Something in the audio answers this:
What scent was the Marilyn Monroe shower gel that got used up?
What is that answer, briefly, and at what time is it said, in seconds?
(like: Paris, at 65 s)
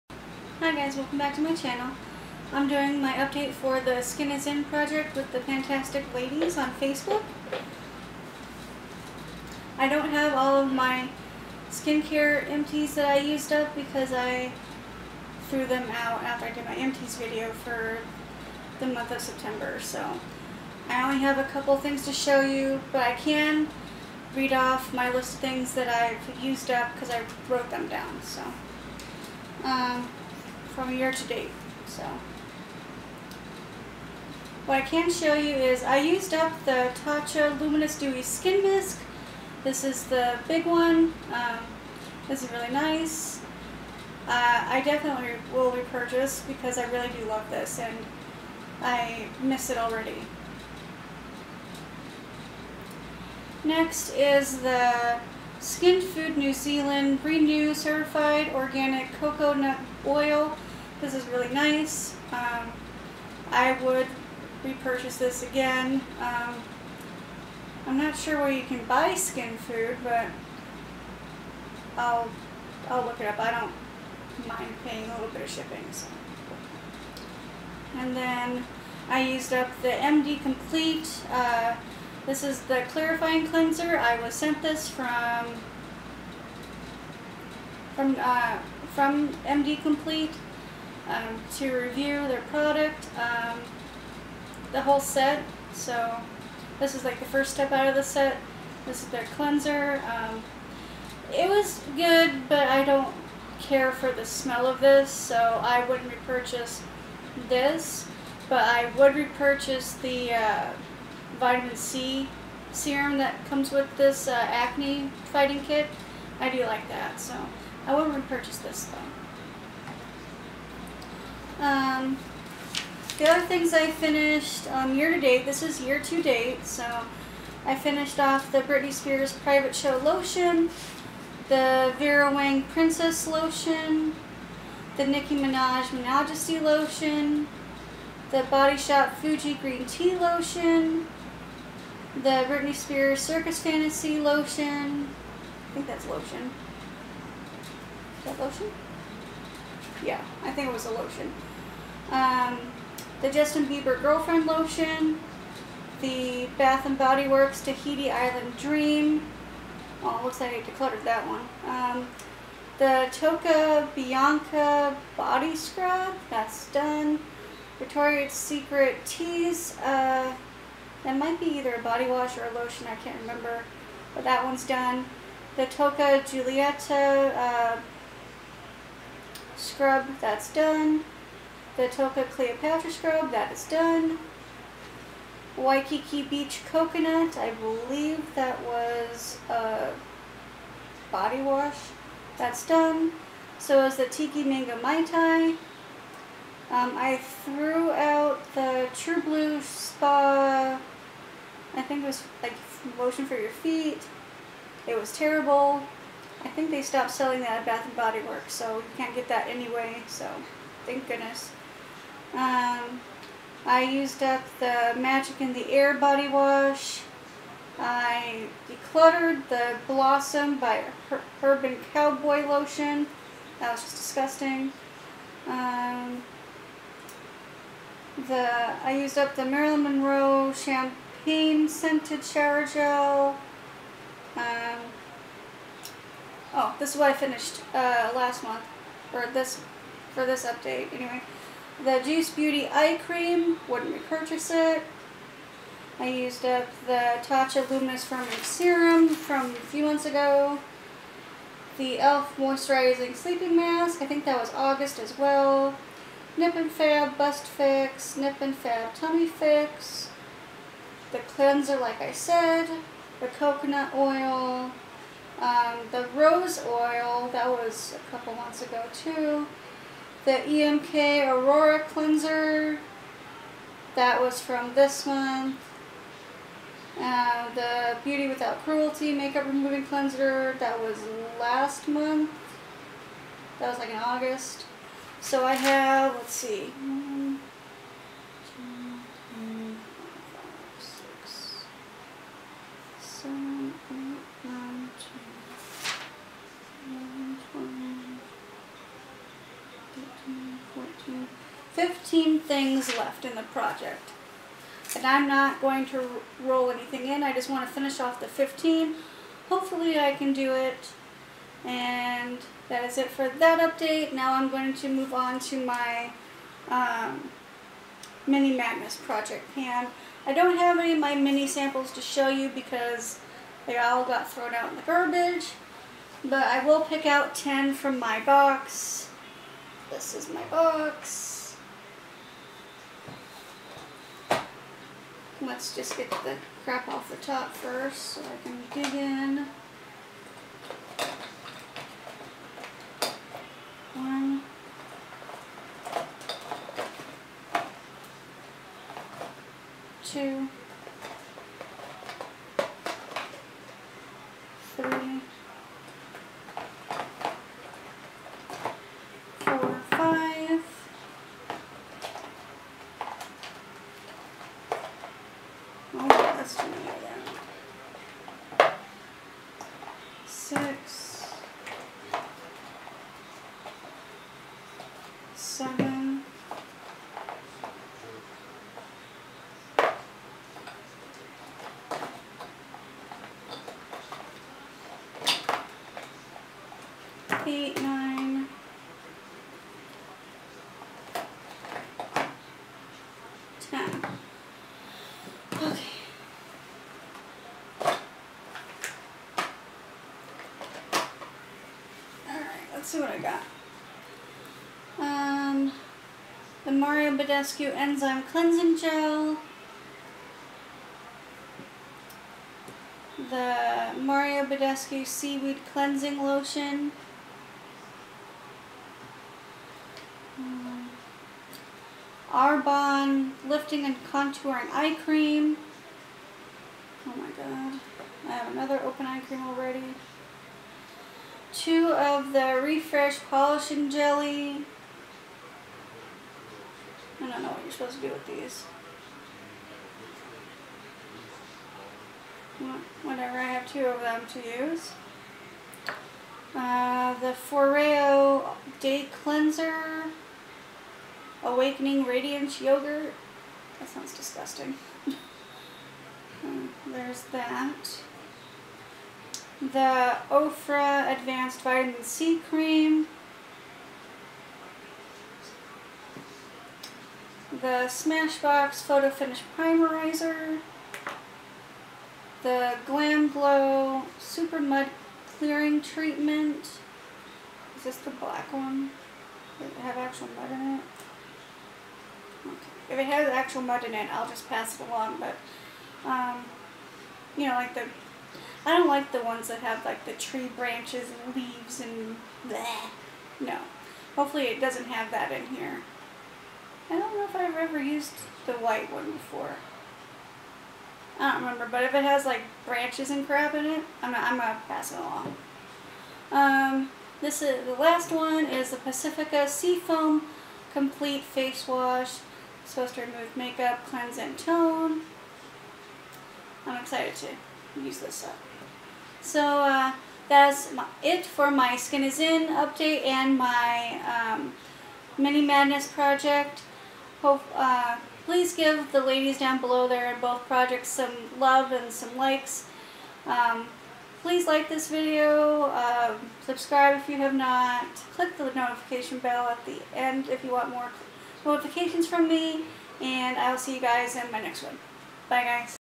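Champagne, at 230 s.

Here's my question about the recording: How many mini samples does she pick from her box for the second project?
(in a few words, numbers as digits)
10.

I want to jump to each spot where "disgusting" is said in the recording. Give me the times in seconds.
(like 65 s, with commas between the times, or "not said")
223 s, 454 s.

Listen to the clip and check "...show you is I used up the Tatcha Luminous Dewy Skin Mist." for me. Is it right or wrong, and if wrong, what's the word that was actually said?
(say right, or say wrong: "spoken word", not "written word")
right.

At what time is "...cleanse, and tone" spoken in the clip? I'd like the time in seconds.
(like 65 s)
513 s.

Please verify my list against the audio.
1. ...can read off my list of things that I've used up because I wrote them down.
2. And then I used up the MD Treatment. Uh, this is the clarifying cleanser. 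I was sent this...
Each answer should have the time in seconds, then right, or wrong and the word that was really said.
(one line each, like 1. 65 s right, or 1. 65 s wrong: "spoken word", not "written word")
1. 23 s right
2. 77 s wrong: "Complete", not "Treatment".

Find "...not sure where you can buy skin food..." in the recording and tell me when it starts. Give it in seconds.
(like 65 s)
67 s.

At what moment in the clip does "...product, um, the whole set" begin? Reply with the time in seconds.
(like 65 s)
92 s.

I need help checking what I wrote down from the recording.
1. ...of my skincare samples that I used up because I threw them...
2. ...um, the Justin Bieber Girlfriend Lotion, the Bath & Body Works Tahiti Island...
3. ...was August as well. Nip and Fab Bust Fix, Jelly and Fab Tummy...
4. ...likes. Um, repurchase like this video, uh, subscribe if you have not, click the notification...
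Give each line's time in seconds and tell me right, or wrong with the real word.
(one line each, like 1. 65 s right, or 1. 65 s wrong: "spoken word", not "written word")
1. 10 s wrong: "empties", not "samples"
2. 152 s right
3. 254 s wrong: "Nip", not "Jelly"
4. 532 s wrong: "please", not "repurchase".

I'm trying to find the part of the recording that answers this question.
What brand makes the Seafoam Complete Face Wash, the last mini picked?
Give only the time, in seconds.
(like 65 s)
508 s.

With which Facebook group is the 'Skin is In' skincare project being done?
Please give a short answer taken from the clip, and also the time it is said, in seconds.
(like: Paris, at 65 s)
Pantastic Ladies, at 5 s.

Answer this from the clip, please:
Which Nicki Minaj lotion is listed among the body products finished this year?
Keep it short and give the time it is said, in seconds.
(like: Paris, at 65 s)
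Minajesty, at 135 s.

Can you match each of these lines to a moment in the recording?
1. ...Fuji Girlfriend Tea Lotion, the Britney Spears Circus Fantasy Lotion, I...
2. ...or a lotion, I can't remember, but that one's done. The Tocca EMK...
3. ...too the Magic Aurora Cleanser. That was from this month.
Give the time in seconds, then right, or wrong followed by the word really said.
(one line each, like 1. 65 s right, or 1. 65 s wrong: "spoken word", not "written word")
1. 139 s wrong: "Green", not "Girlfriend"
2. 172 s wrong: "Giulietta", not "EMK"
3. 268 s wrong: "EMK", not "Magic".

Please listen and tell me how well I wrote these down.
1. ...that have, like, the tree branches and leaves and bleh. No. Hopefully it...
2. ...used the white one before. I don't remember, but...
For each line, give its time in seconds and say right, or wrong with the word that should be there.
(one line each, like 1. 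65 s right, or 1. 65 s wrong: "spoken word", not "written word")
1. 489 s right
2. 497 s right.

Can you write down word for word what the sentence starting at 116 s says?
I do like that, so I wouldn't repurchase this though.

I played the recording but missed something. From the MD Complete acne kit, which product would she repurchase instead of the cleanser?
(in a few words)
vitamin C serum.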